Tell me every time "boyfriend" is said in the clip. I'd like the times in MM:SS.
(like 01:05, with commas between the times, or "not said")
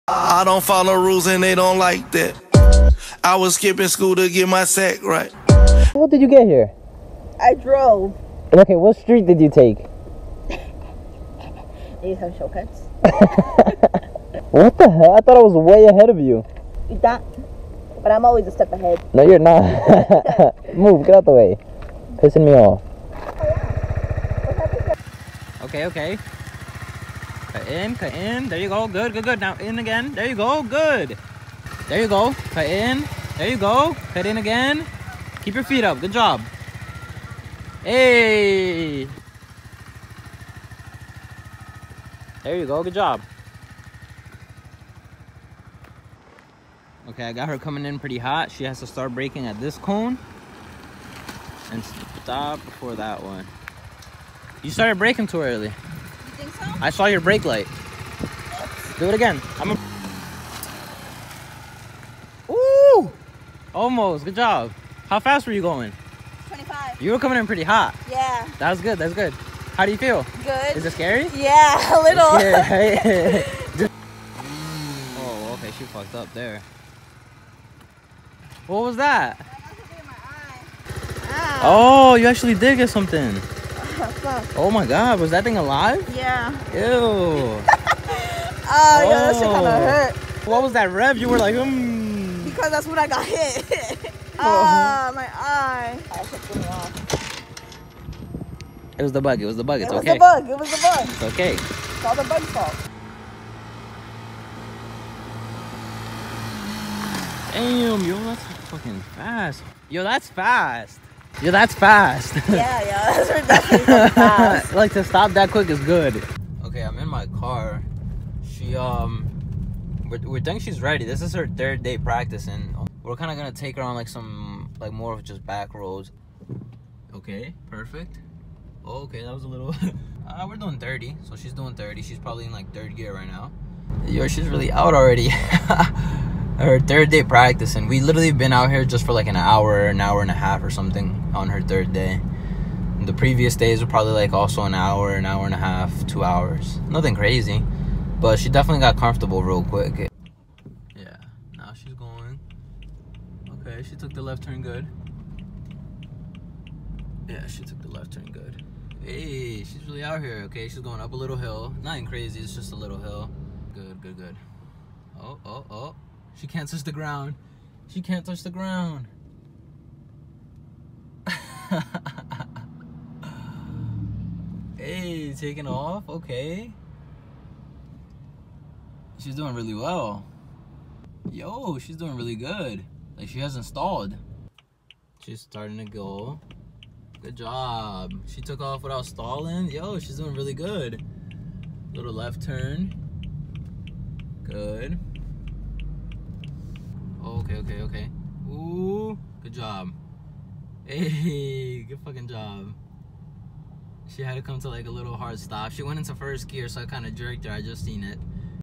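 not said.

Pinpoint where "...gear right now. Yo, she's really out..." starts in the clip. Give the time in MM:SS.
02:12.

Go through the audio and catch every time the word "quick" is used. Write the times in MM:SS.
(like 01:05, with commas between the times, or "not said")
01:55, 02:29.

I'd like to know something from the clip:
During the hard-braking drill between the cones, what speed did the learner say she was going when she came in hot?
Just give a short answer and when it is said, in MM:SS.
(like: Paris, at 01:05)
25, at 01:06.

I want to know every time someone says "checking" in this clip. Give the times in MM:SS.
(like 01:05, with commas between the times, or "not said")
not said.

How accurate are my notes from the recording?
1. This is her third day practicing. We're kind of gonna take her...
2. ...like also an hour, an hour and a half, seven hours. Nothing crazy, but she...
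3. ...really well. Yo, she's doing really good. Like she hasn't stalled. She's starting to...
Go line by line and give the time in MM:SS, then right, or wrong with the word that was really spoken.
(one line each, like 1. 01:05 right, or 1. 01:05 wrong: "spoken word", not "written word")
1. 02:01 right
2. 02:24 wrong: "two", not "seven"
3. 02:59 right.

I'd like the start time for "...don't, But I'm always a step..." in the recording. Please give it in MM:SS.
00:16.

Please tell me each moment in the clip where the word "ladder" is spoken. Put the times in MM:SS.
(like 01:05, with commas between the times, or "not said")
not said.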